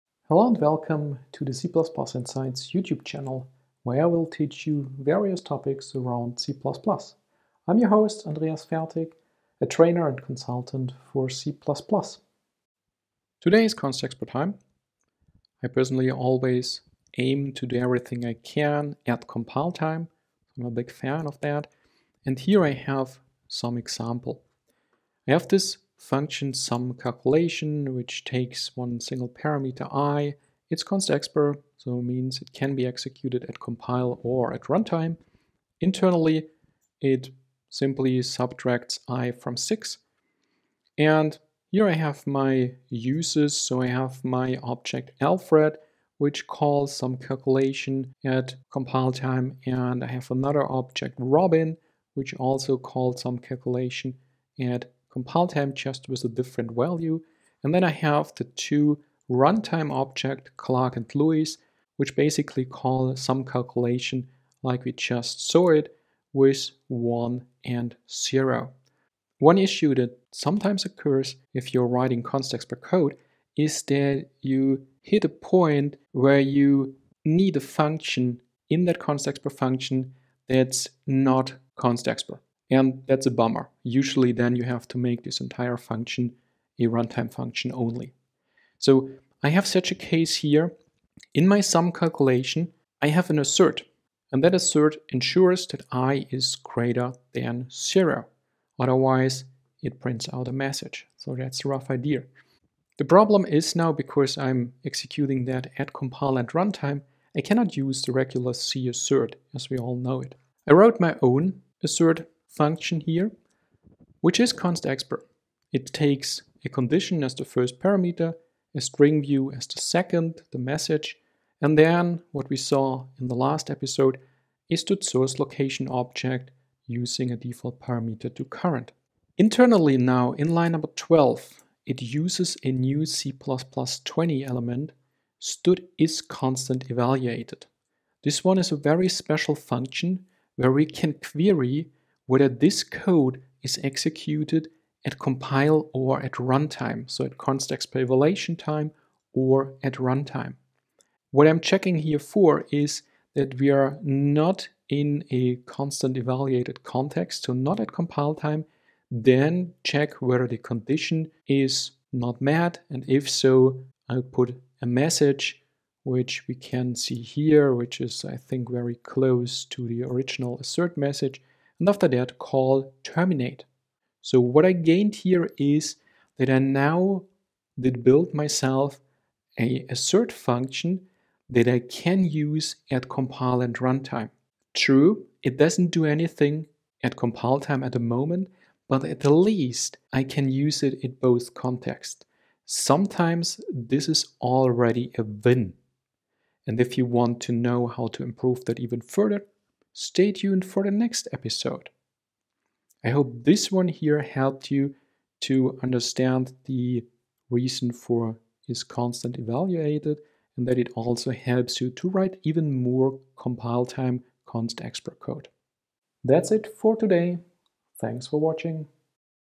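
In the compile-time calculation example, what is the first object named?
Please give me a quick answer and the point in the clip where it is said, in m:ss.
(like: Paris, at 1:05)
Alfred, at 0:45.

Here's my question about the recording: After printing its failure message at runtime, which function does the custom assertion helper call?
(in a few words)
terminate.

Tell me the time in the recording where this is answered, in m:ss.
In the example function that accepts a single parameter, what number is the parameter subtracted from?
0:39.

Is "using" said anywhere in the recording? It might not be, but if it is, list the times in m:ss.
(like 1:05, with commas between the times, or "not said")
2:06.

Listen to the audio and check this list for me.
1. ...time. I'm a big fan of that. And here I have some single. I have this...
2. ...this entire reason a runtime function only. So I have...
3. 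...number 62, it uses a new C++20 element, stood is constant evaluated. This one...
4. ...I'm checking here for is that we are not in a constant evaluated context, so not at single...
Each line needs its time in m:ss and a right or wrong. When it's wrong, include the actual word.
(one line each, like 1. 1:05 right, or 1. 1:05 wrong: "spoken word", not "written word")
1. 0:19 wrong: "example", not "single"
2. 1:25 wrong: "function", not "reason"
3. 2:10 wrong: "12", not "62"
4. 2:31 wrong: "compile", not "single".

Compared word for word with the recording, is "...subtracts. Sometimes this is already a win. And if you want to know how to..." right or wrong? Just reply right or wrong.
wrong.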